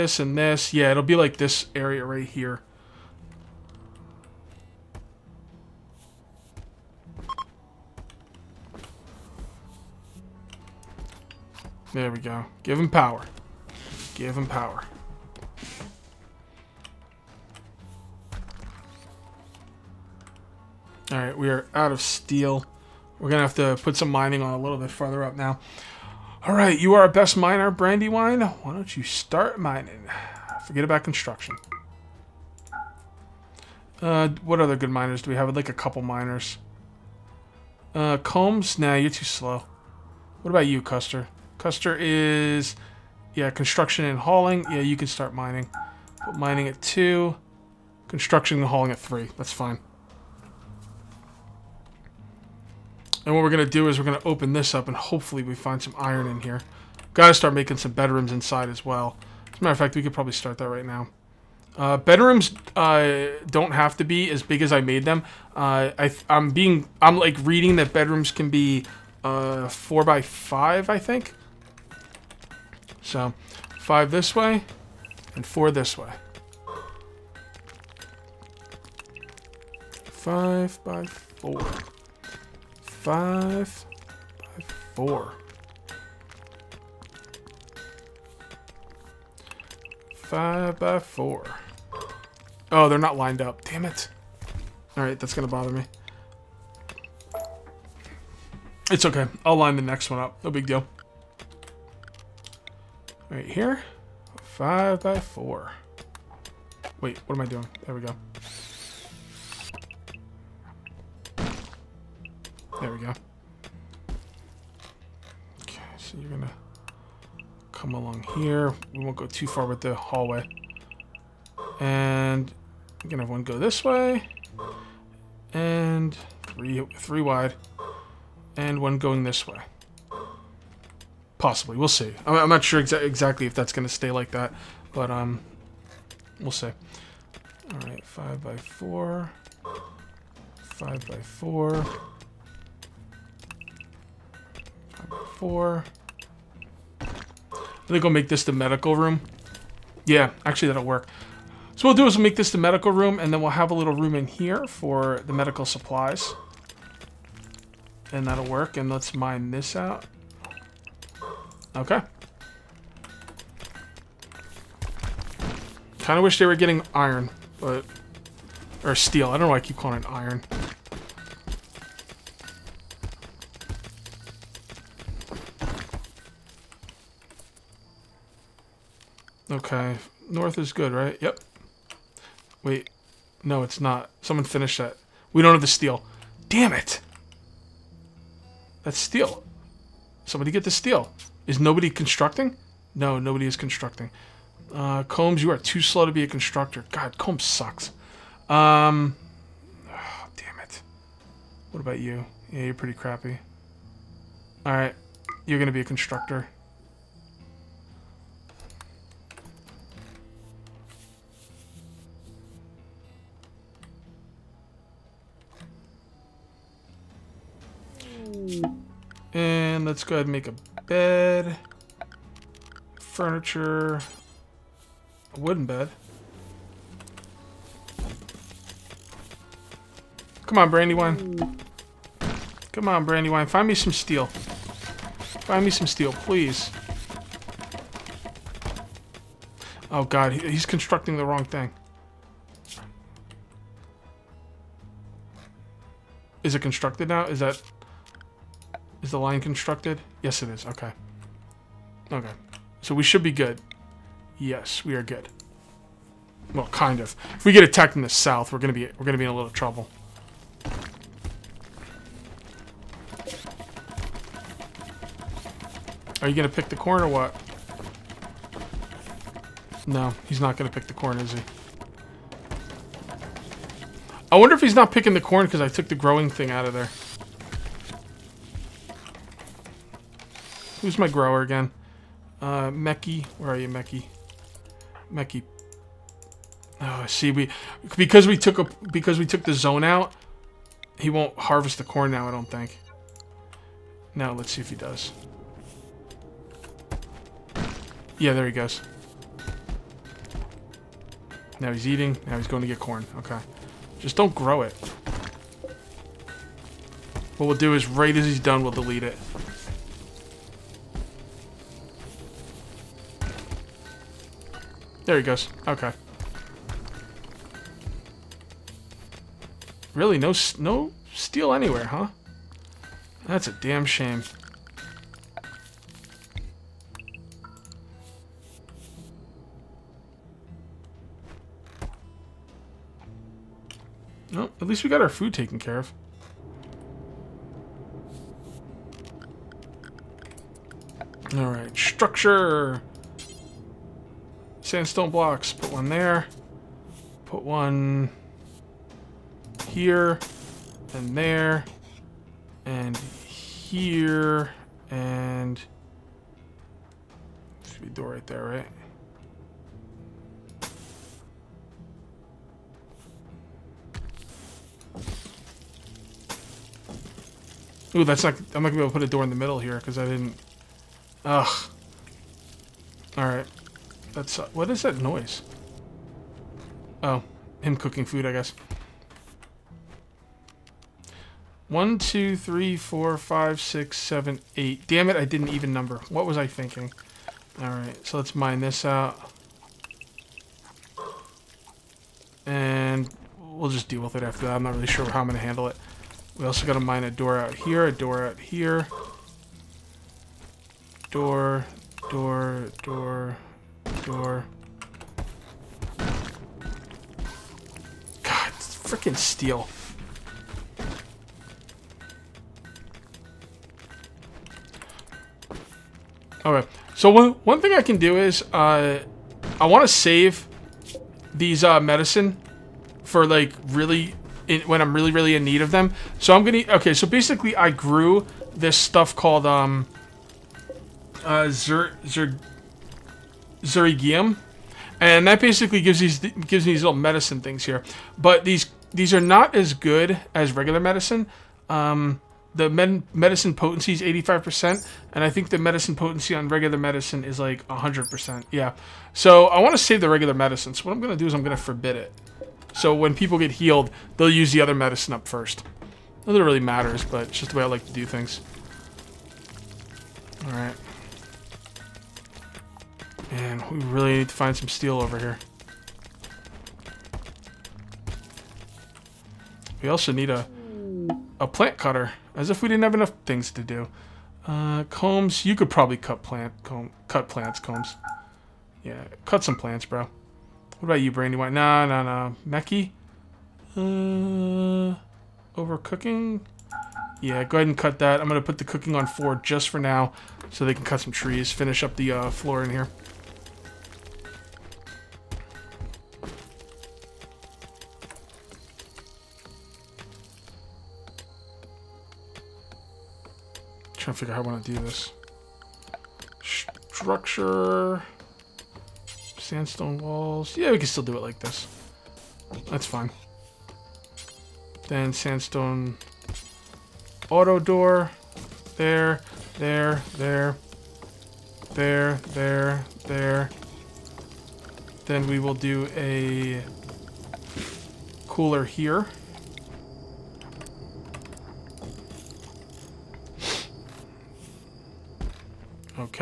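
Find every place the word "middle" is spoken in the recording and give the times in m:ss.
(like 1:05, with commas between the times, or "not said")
6:09.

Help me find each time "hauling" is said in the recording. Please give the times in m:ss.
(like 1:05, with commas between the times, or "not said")
0:44, 0:48.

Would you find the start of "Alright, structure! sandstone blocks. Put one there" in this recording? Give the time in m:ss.
5:41.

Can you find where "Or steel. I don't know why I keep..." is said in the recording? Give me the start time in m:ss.
2:48.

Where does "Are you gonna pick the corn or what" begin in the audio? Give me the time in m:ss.
4:26.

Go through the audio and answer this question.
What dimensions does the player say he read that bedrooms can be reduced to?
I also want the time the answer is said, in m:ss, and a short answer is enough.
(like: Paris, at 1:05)
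4 by 5, at 1:09.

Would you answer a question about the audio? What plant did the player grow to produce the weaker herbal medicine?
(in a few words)
Xerigium.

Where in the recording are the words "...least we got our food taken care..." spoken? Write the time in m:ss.
5:34.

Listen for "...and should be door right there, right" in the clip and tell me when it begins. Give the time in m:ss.
5:54.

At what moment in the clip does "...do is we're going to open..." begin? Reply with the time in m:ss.
0:53.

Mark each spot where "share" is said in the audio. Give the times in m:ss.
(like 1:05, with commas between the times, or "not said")
not said.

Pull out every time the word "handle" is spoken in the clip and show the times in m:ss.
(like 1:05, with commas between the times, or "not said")
6:35.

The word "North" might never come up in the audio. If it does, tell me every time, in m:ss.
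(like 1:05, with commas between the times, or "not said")
3:00.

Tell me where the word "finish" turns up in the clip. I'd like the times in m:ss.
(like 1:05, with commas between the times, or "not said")
3:04, 8:11.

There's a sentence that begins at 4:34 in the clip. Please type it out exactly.
I wonder if he's not picking the corn because I took the growing thing out of there.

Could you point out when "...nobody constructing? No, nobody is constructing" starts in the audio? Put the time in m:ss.
3:11.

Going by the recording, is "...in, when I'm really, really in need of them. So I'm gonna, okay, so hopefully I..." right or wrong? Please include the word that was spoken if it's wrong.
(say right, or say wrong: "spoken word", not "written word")
wrong: "basically", not "hopefully".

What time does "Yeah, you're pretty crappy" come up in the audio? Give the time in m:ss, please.
3:22.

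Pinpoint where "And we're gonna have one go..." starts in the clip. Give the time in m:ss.
2:01.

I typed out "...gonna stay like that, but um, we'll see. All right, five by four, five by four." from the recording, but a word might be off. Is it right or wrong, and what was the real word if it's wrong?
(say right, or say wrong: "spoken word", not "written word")
right.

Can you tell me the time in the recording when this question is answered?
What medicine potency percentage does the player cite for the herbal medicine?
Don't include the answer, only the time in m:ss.
7:24.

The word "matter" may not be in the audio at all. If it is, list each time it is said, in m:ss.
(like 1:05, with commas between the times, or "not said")
0:59, 7:36.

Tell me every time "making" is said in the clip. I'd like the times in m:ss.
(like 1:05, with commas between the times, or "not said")
0:57.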